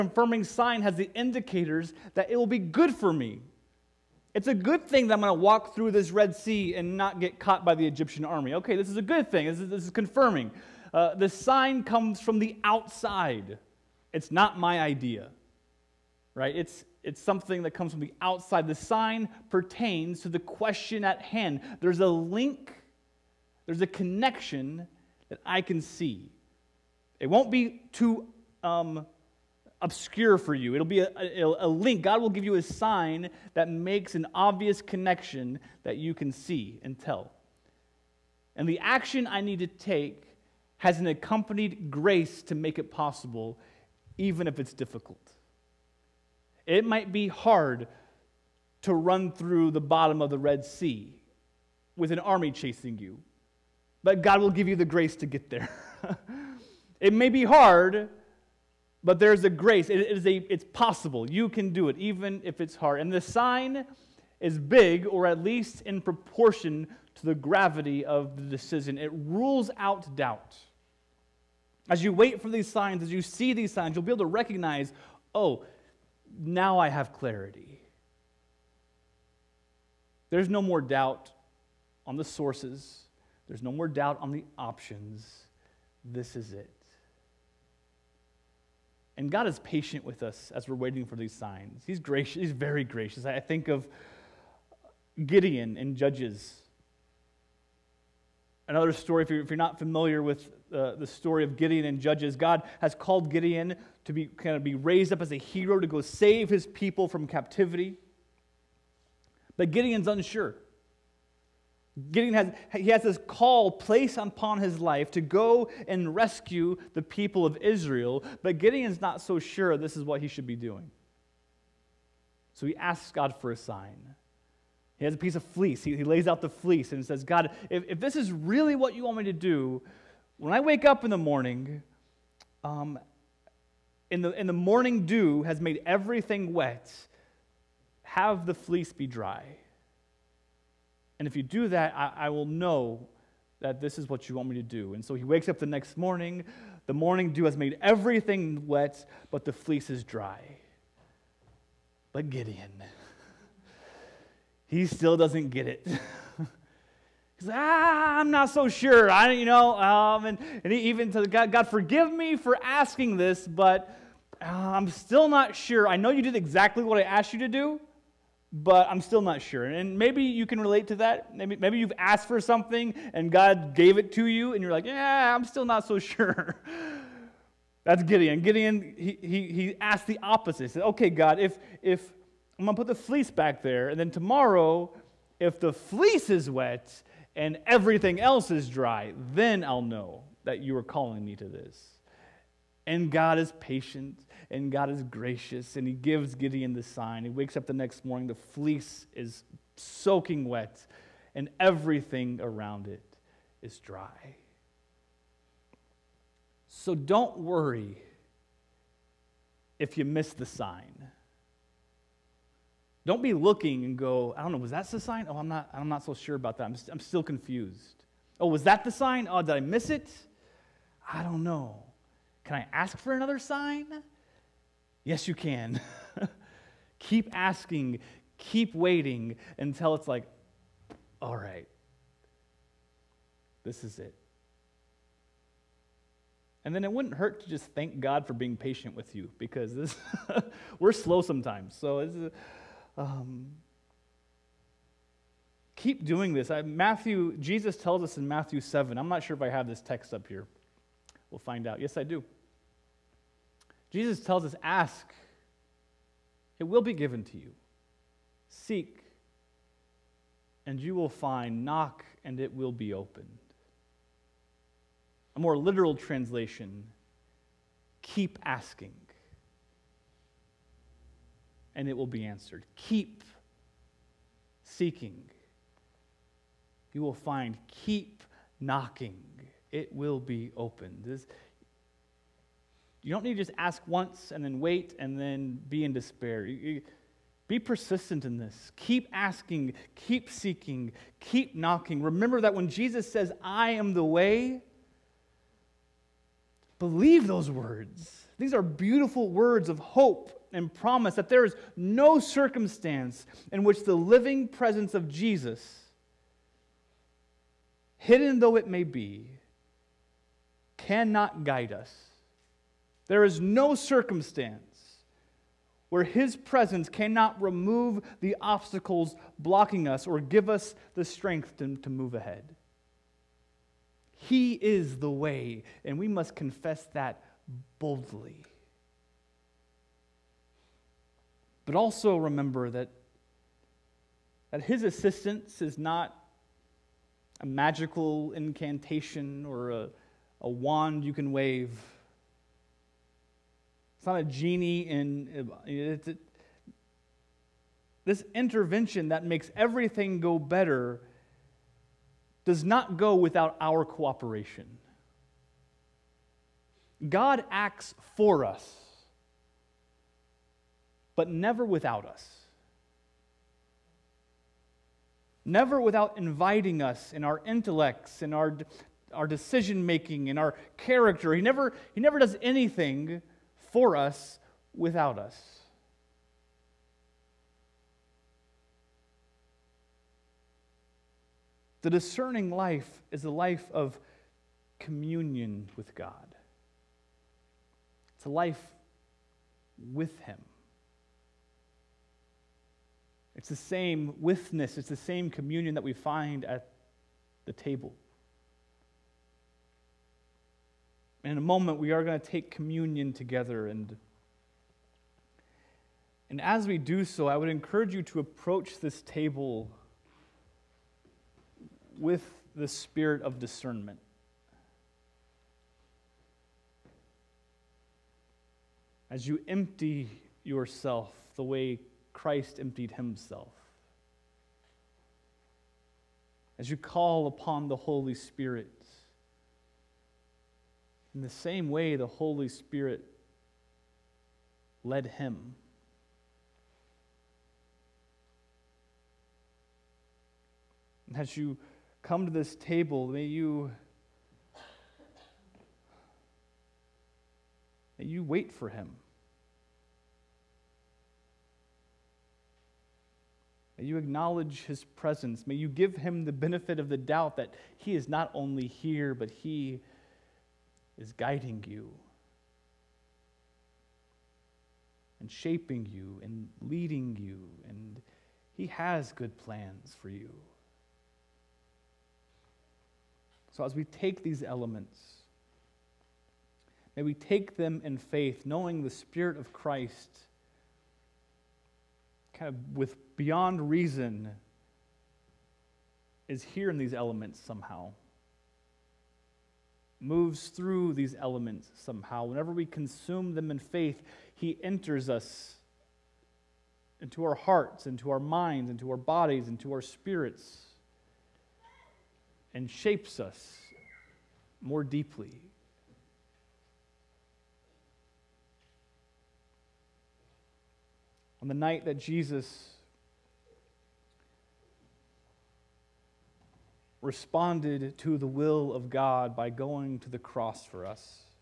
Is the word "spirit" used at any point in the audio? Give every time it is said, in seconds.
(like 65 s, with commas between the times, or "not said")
412 s, 428 s, 432 s, 478 s, 499 s.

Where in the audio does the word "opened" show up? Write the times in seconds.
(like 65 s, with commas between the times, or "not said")
262 s, 280 s.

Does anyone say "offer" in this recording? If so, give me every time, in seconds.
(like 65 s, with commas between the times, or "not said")
not said.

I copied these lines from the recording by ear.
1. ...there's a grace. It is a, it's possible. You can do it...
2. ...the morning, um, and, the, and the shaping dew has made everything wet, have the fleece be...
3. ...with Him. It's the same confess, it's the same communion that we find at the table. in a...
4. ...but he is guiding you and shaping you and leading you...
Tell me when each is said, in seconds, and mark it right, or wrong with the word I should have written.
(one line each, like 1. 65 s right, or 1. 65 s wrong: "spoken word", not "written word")
1. 59 s right
2. 131 s wrong: "morning", not "shaping"
3. 389 s wrong: "withness", not "confess"
4. 459 s right.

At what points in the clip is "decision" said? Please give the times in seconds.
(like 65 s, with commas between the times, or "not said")
68 s, 369 s.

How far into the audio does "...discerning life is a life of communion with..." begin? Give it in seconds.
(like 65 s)
381 s.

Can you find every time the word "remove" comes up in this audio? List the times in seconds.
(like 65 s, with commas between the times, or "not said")
317 s.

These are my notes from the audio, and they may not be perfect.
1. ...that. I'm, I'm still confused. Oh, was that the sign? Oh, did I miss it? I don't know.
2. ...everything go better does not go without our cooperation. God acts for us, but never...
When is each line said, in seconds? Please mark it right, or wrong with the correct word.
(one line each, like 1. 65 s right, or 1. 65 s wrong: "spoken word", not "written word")
1. 216 s right
2. 349 s right.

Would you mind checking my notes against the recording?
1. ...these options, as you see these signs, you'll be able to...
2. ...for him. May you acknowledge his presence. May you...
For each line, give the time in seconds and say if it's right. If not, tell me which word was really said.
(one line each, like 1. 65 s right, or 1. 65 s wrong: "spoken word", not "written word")
1. 72 s wrong: "signs", not "options"
2. 448 s right.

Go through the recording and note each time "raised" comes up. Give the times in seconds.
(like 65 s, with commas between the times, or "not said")
104 s.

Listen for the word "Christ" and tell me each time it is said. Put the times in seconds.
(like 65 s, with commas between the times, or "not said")
422 s, 479 s.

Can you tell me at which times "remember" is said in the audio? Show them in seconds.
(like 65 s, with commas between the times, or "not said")
292 s, 332 s.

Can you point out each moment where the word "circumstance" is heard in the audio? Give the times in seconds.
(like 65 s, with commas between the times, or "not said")
302 s, 313 s.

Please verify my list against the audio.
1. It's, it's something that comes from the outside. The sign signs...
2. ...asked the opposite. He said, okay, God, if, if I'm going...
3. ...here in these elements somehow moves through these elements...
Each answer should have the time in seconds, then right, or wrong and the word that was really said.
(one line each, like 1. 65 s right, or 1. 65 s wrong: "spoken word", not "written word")
1. 16 s wrong: "pertains", not "signs"
2. 179 s right
3. 486 s right.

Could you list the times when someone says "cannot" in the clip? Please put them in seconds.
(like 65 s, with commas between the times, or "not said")
310 s, 316 s.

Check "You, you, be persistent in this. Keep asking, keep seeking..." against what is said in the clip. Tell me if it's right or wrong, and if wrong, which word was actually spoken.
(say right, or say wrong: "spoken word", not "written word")
right.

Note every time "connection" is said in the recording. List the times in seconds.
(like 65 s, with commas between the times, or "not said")
23 s, 34 s.